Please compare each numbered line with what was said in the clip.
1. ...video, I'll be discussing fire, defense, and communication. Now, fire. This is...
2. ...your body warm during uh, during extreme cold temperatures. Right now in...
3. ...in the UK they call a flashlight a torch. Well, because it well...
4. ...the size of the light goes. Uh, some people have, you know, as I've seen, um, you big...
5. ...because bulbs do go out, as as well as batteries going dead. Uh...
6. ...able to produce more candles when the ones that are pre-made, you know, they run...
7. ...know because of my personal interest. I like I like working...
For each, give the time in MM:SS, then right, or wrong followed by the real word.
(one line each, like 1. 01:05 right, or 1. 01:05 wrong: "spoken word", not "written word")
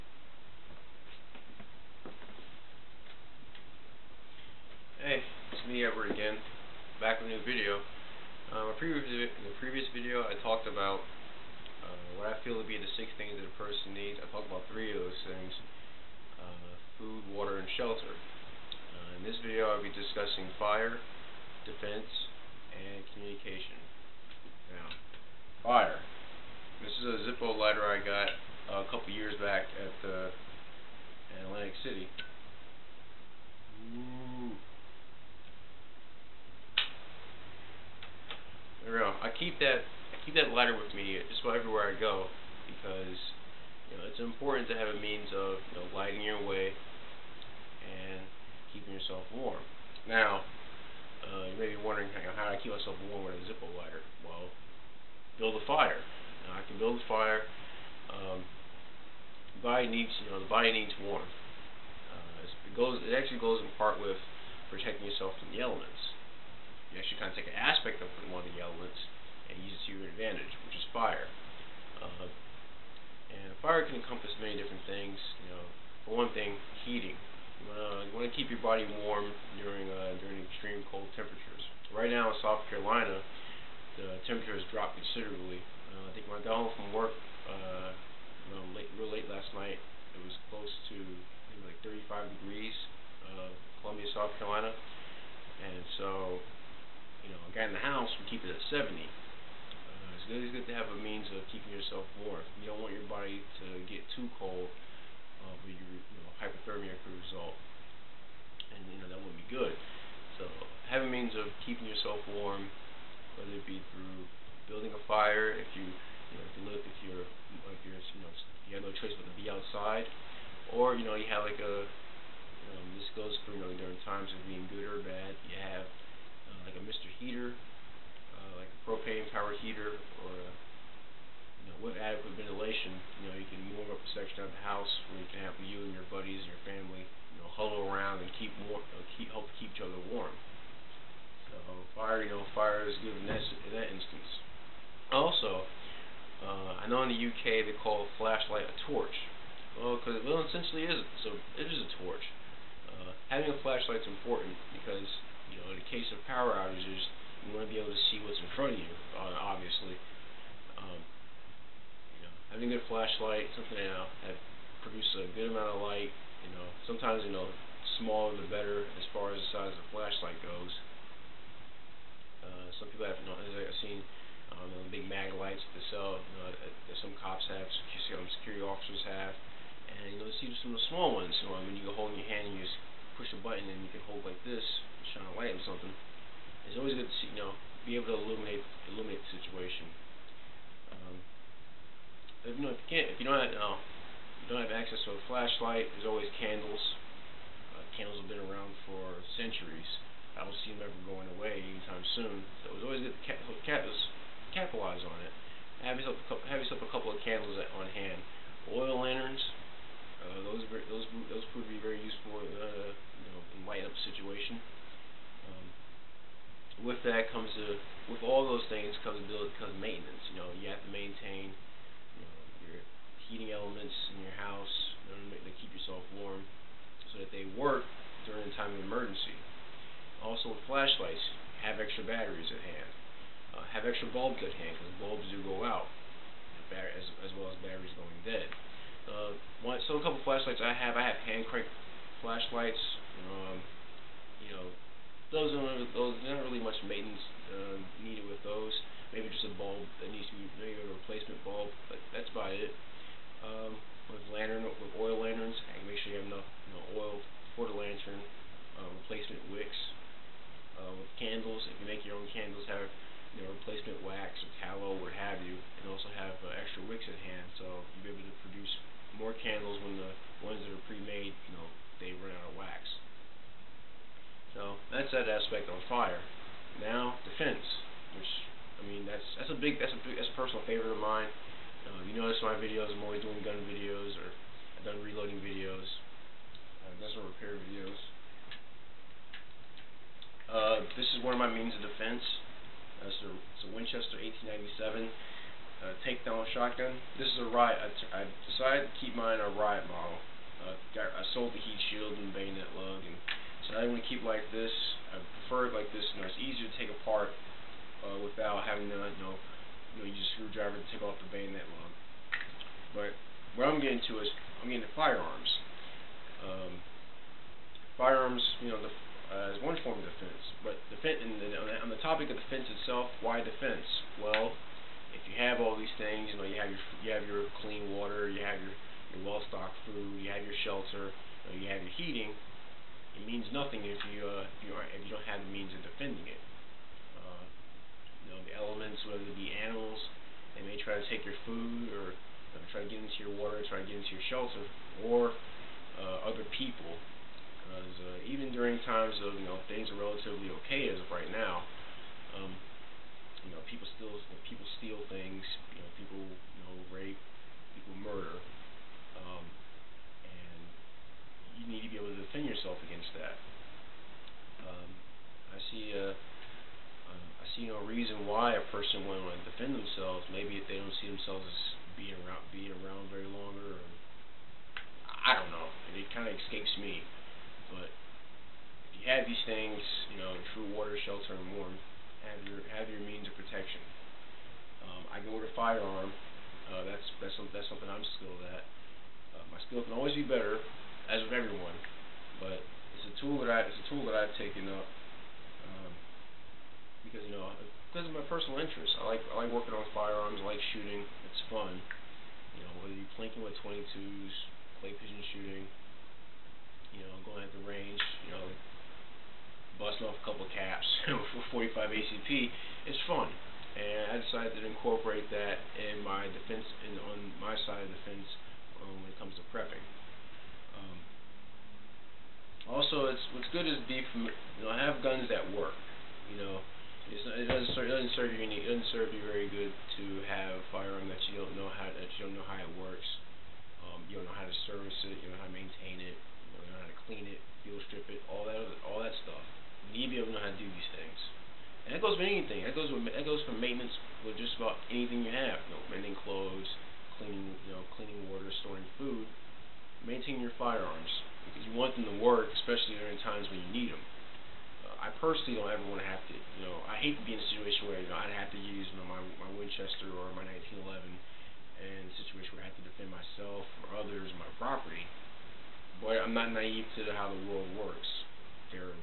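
1. 00:19 right
2. 01:18 right
3. 02:27 right
4. 02:49 wrong: "flashlight", not "light"
5. 03:54 right
6. 04:28 right
7. 06:37 right.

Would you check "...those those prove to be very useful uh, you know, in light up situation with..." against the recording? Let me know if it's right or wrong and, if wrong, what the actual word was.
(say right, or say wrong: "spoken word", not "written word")
right.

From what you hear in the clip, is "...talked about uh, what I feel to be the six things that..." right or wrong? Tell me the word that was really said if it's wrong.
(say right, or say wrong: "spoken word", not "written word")
right.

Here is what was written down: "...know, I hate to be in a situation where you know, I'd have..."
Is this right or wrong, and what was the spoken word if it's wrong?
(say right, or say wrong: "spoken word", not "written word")
right.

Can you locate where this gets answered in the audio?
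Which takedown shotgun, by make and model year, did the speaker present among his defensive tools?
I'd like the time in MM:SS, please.
04:53.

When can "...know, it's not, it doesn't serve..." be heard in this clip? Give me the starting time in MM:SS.
07:06.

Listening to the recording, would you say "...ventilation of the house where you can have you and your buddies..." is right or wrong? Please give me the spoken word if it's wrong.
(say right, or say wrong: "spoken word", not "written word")
wrong: "section", not "ventilation".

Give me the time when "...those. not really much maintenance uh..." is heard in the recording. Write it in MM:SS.
04:05.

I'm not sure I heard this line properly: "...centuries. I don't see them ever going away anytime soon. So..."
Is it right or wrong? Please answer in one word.
right.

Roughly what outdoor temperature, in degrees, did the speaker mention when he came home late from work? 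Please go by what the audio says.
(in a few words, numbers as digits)
35.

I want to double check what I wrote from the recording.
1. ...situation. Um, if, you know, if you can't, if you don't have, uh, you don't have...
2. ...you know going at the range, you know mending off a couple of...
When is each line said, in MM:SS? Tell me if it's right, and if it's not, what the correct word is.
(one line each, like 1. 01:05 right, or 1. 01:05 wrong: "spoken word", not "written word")
1. 03:09 right
2. 06:46 wrong: "busting", not "mending".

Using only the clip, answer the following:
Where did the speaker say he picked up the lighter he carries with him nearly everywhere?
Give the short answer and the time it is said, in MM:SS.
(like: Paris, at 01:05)
Atlantic City, at 00:31.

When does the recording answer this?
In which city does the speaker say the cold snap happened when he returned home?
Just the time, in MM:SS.
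01:33.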